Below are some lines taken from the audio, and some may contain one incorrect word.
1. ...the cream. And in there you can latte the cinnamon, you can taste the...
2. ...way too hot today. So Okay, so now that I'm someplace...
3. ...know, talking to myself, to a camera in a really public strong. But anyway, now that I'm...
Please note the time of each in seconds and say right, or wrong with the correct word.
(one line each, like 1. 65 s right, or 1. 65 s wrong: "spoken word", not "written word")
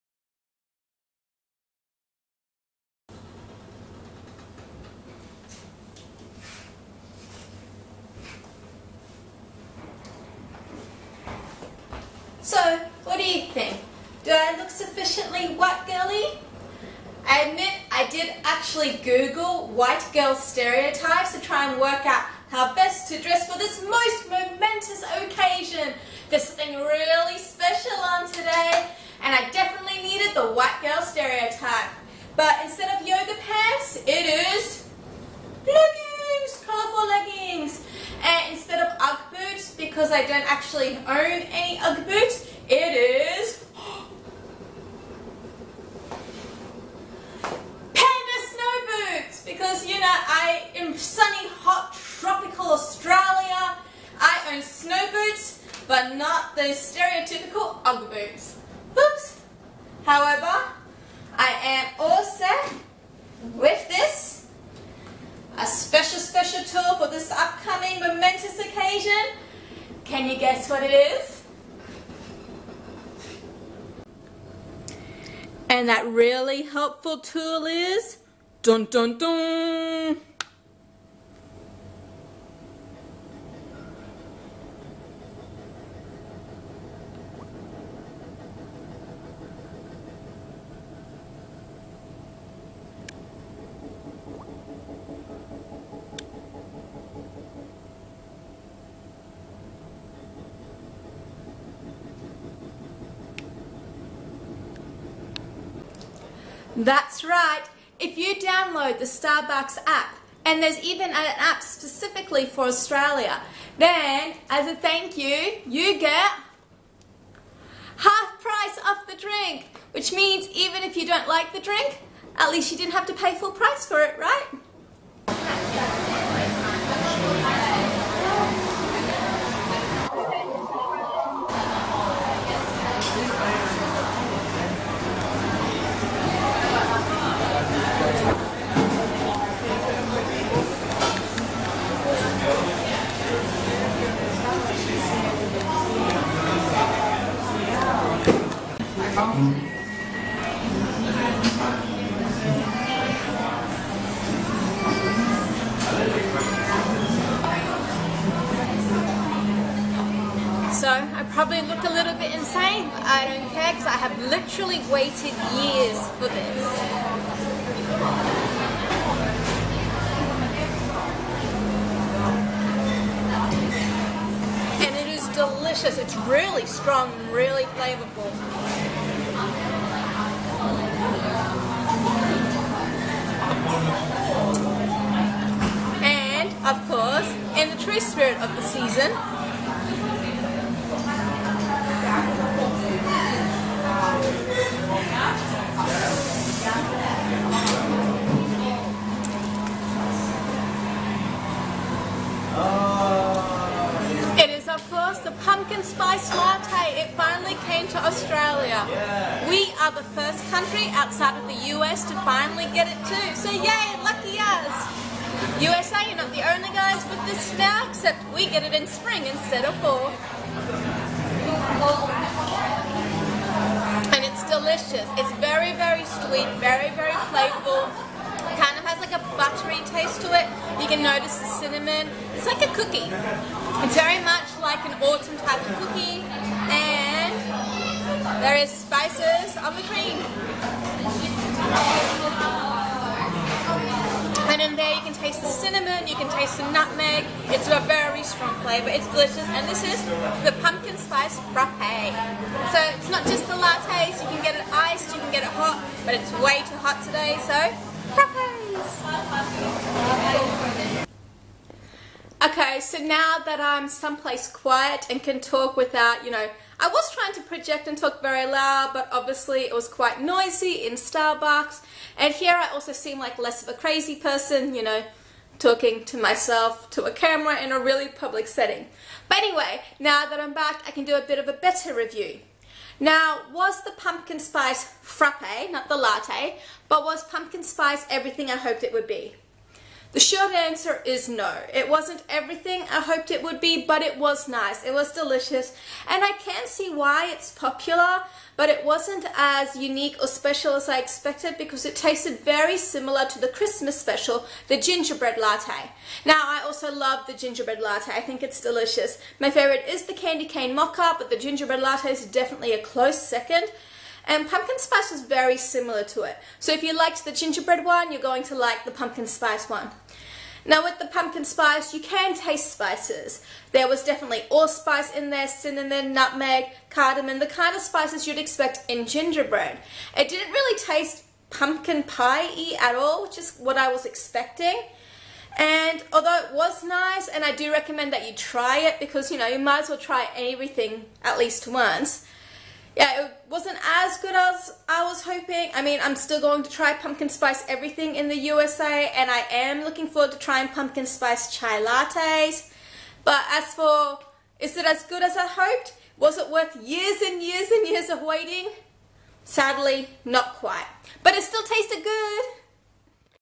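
1. 239 s wrong: "taste", not "latte"
2. 256 s right
3. 274 s wrong: "setting", not "strong".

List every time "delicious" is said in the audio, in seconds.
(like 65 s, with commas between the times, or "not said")
175 s, 224 s, 249 s, 295 s, 308 s.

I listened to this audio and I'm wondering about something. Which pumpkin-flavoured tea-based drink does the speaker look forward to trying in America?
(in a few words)
Pumpkin spice chai lattes.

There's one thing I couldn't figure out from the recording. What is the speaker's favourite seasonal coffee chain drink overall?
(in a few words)
Candy cane mocha.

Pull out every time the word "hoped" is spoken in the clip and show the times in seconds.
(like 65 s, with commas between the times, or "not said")
288 s, 292 s, 355 s.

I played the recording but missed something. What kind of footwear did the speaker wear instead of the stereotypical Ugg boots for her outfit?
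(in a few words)
Panda Snow Boots.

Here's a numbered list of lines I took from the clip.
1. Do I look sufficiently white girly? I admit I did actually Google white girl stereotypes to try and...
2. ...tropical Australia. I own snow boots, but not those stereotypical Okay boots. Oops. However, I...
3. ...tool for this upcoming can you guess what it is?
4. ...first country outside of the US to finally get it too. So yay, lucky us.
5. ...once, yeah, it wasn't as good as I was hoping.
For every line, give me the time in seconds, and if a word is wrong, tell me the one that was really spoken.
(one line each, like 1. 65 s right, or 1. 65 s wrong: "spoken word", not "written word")
1. 14 s right
2. 51 s wrong: "Ugg", not "Okay"
3. 66 s right
4. 210 s right
5. 341 s right.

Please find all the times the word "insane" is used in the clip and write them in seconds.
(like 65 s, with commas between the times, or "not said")
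162 s.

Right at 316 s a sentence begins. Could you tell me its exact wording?
So if you liked the gingerbread one, you're going to like the pumpkin spice one.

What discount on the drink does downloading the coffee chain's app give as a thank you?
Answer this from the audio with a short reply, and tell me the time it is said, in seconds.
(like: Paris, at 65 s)
Half price, at 117 s.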